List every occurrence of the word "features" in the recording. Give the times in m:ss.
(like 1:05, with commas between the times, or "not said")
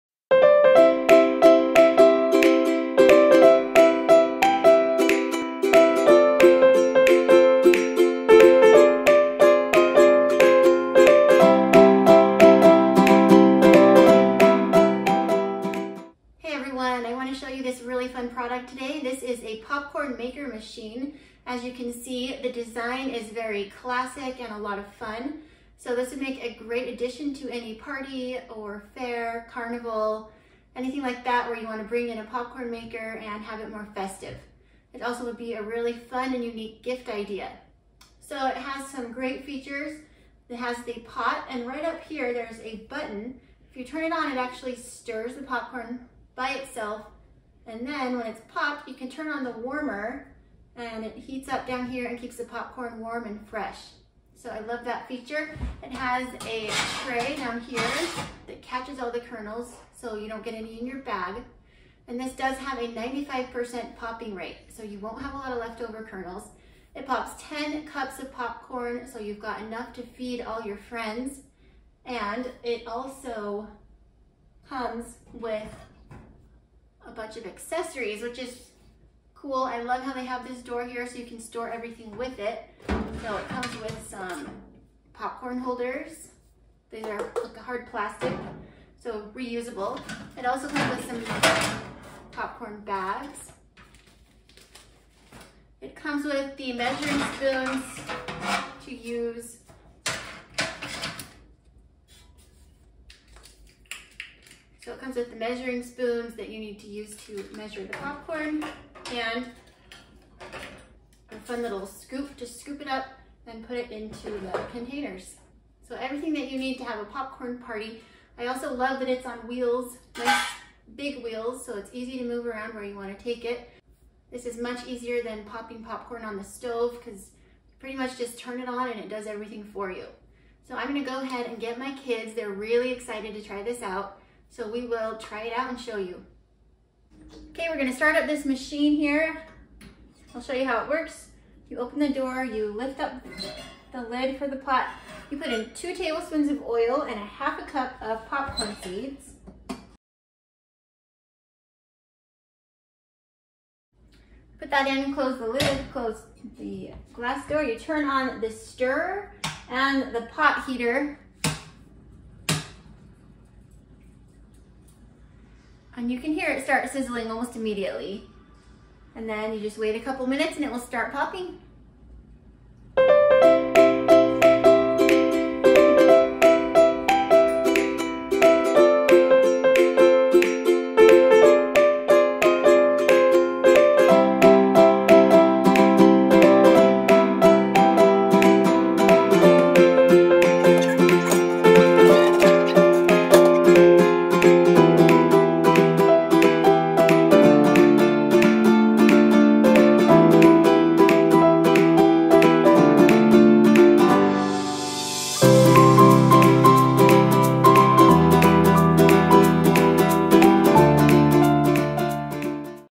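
0:39, 0:55.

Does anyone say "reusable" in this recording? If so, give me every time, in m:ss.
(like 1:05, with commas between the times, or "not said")
1:29.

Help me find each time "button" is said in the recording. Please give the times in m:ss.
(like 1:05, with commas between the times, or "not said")
0:42.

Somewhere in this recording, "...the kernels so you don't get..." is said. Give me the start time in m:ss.
0:59.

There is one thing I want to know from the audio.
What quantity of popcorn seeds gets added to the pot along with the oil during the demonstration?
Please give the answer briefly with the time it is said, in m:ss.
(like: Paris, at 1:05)
half a cup, at 2:27.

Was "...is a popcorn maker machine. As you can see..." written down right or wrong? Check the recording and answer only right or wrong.
right.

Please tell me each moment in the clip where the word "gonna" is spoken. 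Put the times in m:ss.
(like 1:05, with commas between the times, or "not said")
2:10, 2:17.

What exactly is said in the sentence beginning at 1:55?
So everything that you need to have a popcorn party.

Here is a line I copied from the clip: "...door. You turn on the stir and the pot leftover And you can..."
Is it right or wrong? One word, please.
wrong.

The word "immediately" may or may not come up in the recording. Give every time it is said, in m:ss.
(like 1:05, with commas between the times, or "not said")
2:47.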